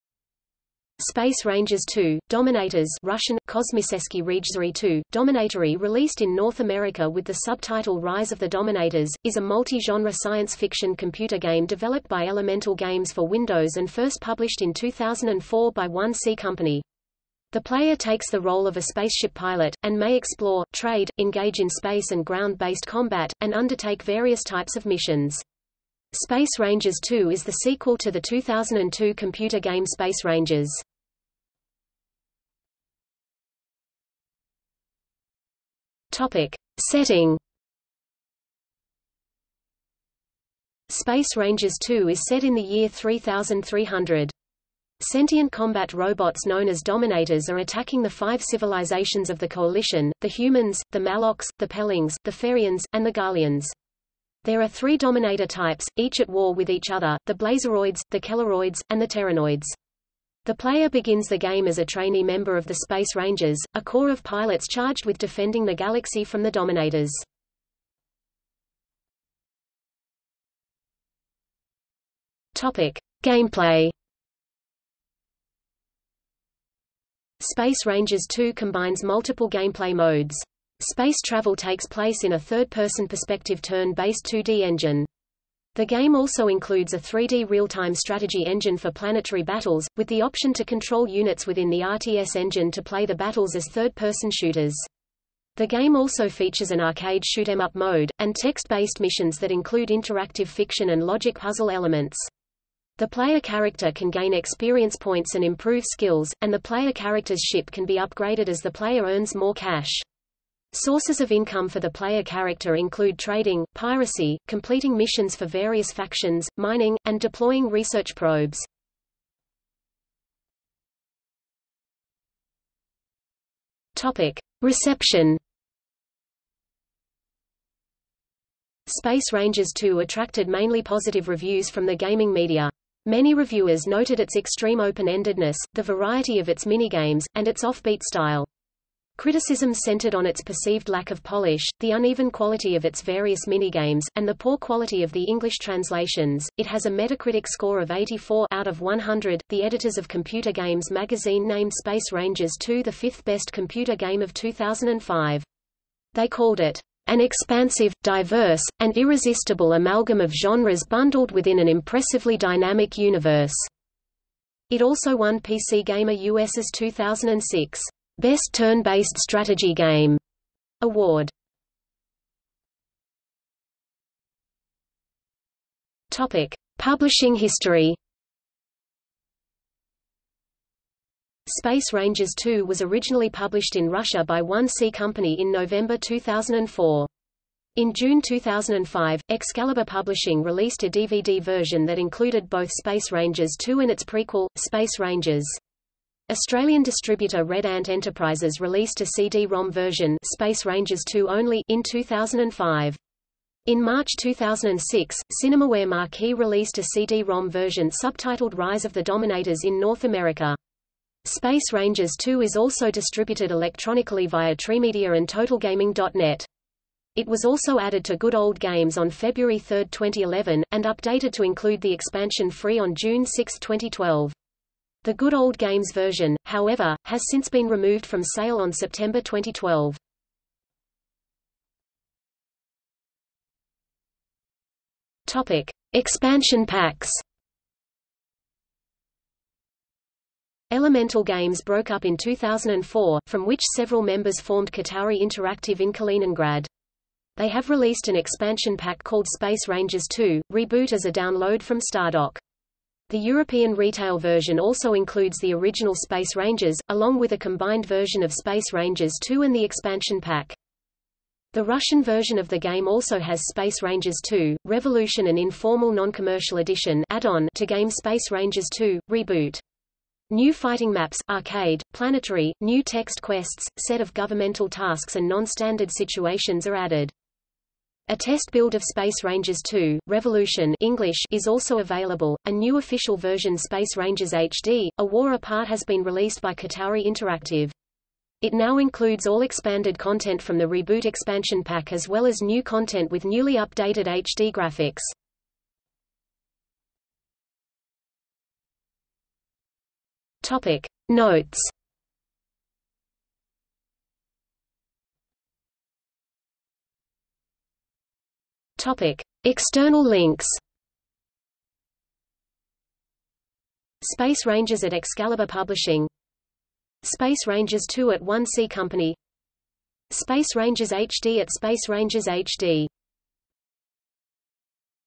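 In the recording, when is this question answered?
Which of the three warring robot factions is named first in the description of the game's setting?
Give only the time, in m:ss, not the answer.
0:57.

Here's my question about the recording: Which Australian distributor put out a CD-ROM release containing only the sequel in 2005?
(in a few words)
Red Ant Enterprises.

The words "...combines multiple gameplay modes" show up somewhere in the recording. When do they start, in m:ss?
1:18.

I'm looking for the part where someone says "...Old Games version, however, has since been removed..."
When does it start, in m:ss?
3:45.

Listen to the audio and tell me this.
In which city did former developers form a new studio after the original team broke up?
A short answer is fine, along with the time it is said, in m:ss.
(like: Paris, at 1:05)
Kaliningrad, at 4:05.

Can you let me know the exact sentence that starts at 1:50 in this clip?
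Sources of income for the player character include trading, piracy, completing missions for various factions, mining, and deploying research probes.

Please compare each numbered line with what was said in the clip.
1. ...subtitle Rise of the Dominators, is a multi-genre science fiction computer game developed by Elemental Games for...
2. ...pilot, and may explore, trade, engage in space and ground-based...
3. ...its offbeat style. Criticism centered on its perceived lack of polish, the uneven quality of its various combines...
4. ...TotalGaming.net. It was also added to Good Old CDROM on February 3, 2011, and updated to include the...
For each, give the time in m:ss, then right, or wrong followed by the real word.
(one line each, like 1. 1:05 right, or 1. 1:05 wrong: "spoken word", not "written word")
1. 0:07 right
2. 0:19 right
3. 2:17 wrong: "minigames", not "combines"
4. 3:35 wrong: "Games", not "CDROM".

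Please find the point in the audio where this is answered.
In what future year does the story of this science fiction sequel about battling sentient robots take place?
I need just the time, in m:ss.
0:42.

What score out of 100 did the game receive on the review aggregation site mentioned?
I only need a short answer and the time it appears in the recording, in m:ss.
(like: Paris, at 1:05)
84, at 2:27.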